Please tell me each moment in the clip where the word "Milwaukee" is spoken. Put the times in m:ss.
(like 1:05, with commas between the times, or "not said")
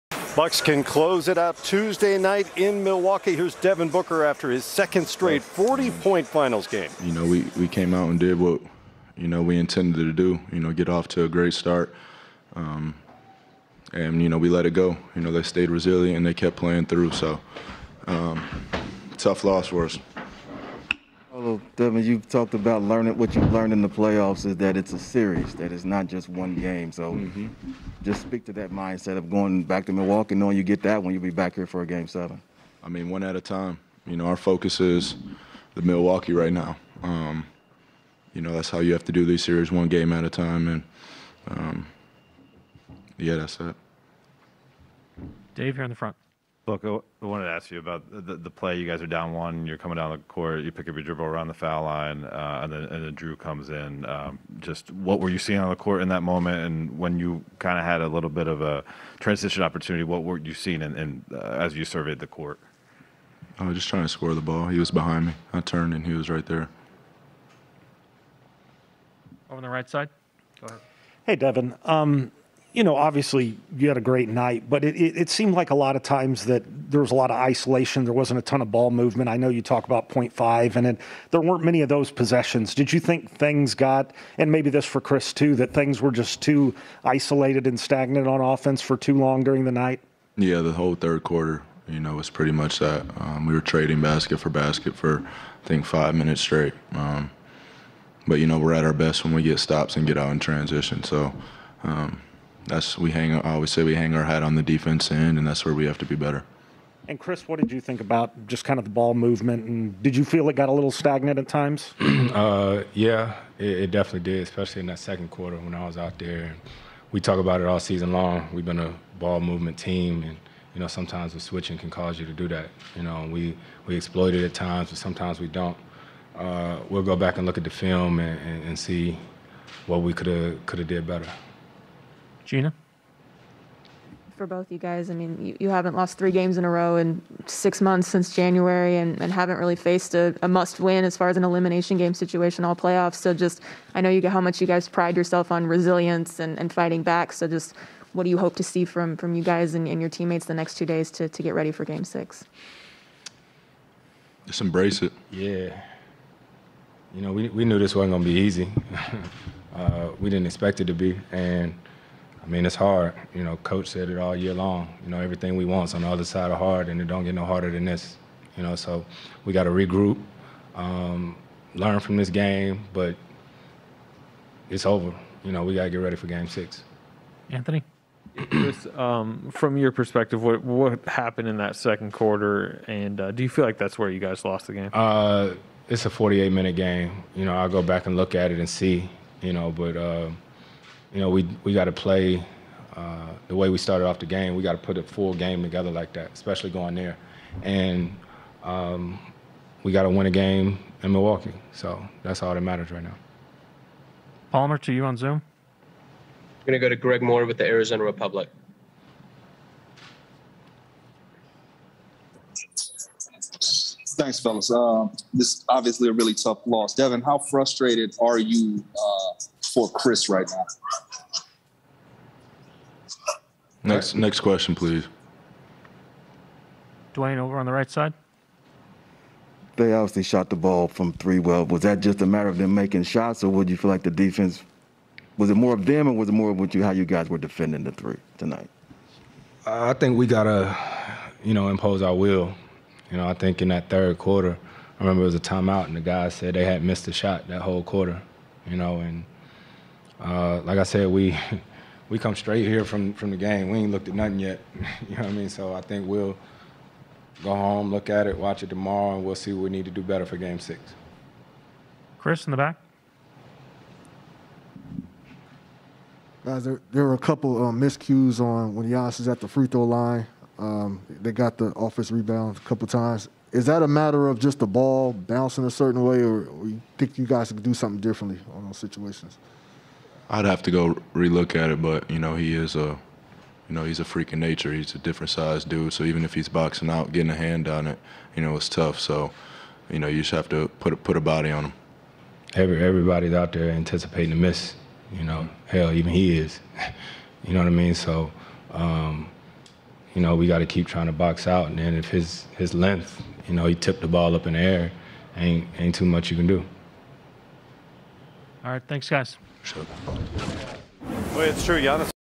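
0:02, 0:29, 0:35, 3:21.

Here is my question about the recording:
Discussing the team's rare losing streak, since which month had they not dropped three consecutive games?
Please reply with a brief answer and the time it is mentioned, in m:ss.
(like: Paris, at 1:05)
January, at 2:18.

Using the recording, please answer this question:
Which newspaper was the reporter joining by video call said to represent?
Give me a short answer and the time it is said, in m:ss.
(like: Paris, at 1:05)
Arizona Republic, at 3:27.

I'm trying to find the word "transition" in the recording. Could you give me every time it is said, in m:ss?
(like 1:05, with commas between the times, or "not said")
0:59, 1:40.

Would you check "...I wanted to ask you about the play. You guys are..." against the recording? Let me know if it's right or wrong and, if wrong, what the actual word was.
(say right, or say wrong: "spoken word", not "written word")
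right.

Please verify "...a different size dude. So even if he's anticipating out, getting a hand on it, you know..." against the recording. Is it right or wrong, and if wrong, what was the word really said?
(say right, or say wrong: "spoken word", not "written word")
wrong: "boxing", not "anticipating".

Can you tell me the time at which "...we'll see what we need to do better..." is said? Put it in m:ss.
4:19.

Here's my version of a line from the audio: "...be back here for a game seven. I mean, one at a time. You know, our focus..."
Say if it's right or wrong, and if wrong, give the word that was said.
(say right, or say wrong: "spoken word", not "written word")
right.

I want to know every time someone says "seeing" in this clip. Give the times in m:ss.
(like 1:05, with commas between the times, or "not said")
0:55, 1:00.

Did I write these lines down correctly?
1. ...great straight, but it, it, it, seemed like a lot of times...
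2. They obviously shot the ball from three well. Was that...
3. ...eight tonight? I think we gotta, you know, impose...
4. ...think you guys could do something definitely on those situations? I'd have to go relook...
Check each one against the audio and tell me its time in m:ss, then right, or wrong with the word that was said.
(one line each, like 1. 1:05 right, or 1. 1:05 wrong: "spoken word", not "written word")
1. 1:14 wrong: "night", not "straight"
2. 3:49 right
3. 3:57 wrong: "three", not "eight"
4. 4:36 wrong: "differently", not "definitely".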